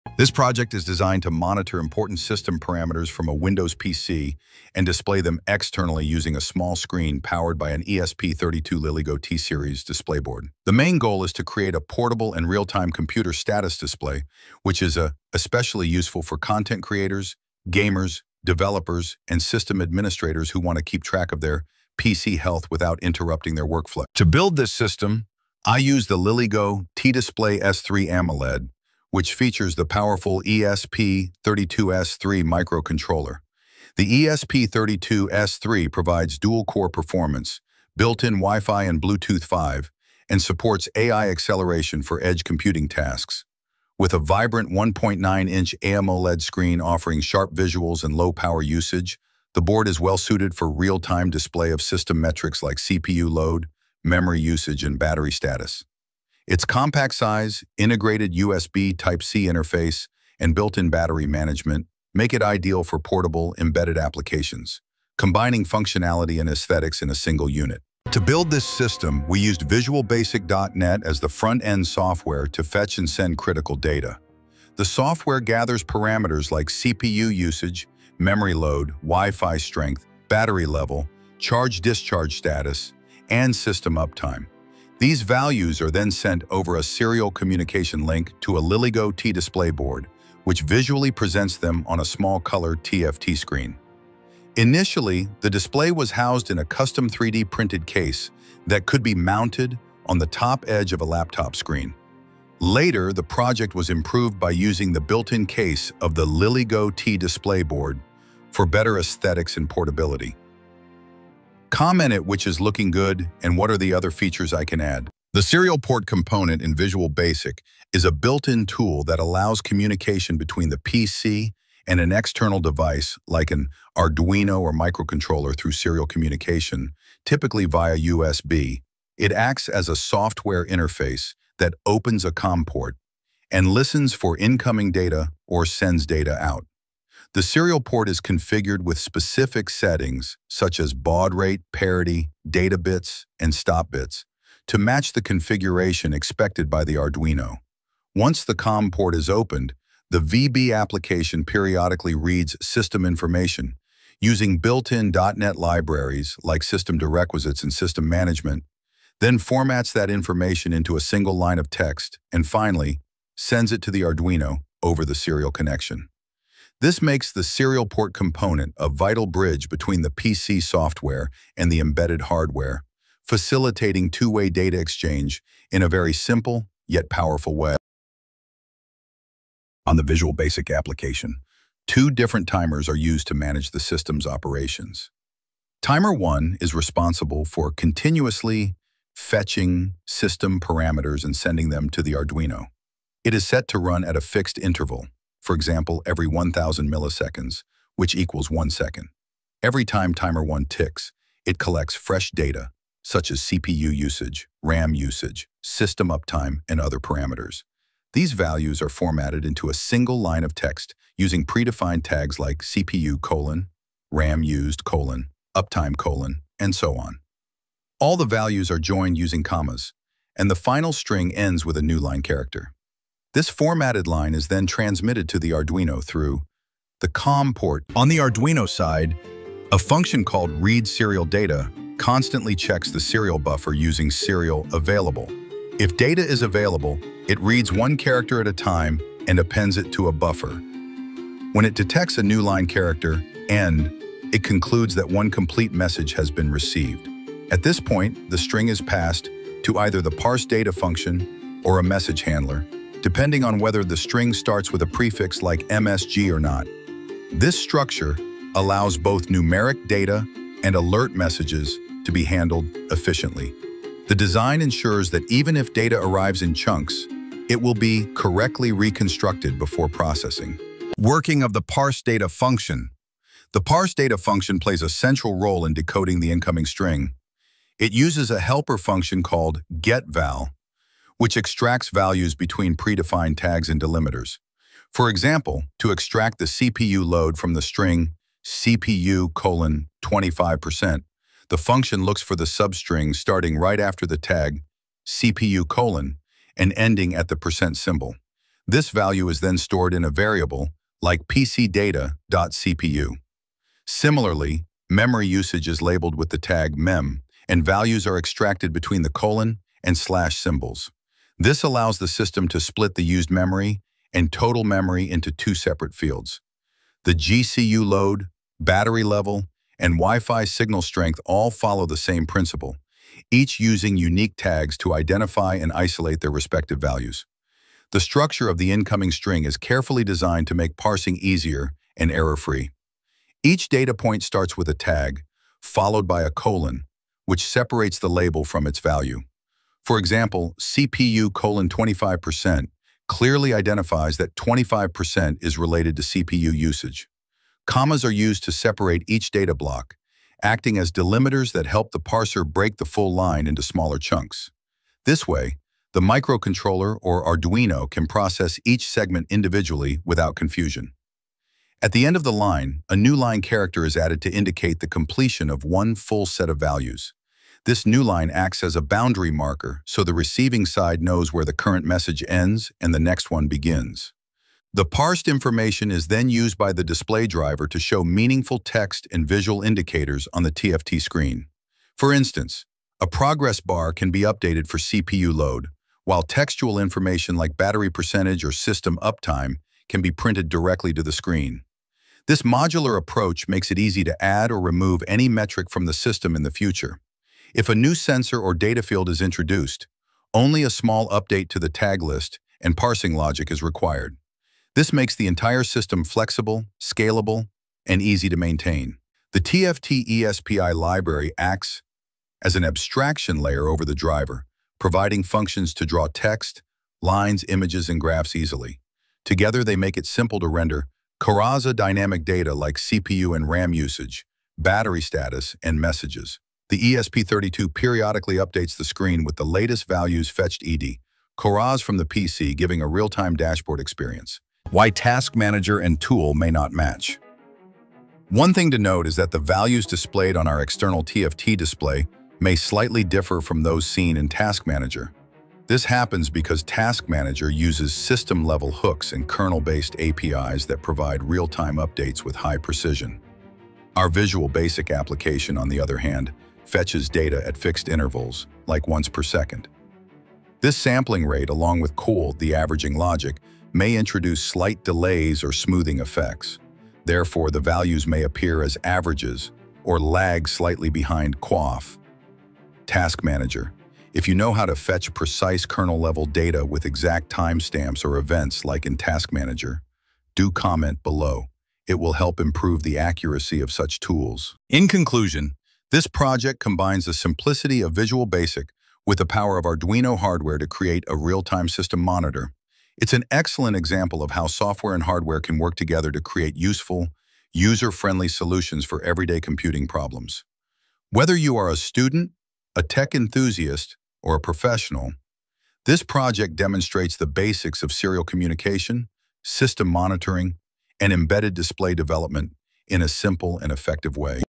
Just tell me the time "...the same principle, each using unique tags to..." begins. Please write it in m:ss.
5:21.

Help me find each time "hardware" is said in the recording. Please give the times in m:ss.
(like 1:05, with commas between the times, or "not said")
2:52, 8:10, 8:15.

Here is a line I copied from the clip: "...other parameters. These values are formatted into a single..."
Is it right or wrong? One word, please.
right.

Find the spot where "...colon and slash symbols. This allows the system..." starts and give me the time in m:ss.
5:09.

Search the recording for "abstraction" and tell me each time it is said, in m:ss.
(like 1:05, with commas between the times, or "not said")
6:52.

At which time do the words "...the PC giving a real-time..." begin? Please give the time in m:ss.
7:11.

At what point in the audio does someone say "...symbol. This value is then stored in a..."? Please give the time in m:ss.
4:57.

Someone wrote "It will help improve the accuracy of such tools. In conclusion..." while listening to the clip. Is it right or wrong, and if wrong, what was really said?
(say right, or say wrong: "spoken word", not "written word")
right.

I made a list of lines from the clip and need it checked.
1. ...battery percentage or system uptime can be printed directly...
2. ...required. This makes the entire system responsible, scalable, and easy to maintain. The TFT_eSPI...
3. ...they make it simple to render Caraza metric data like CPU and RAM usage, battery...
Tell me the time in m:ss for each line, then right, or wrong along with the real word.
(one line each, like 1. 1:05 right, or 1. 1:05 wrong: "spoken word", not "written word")
1. 6:27 right
2. 6:43 wrong: "flexible", not "responsible"
3. 6:59 wrong: "dynamic", not "metric".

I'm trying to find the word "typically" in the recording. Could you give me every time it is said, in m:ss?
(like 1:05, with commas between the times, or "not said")
2:07.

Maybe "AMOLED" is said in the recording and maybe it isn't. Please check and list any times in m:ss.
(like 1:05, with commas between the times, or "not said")
0:28, 0:45.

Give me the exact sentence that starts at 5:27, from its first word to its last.
The structure of the incoming string is carefully designed to make parsing easier and error-free.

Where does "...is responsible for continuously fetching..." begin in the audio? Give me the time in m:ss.
3:06.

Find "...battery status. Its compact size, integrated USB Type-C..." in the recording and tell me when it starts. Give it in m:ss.
0:54.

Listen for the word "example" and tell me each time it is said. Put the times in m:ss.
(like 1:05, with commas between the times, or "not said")
3:15, 4:45, 5:39, 8:13.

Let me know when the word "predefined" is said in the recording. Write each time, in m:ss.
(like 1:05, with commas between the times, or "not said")
3:31, 4:42.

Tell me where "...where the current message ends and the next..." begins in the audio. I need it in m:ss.
6:11.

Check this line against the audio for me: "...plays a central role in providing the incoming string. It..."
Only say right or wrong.
wrong.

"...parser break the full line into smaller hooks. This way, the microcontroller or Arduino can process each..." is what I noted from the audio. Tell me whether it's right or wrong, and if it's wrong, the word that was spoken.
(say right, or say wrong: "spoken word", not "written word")
wrong: "chunks", not "hooks".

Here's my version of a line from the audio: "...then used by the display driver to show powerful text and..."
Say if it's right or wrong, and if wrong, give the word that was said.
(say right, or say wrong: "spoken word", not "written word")
wrong: "meaningful", not "powerful".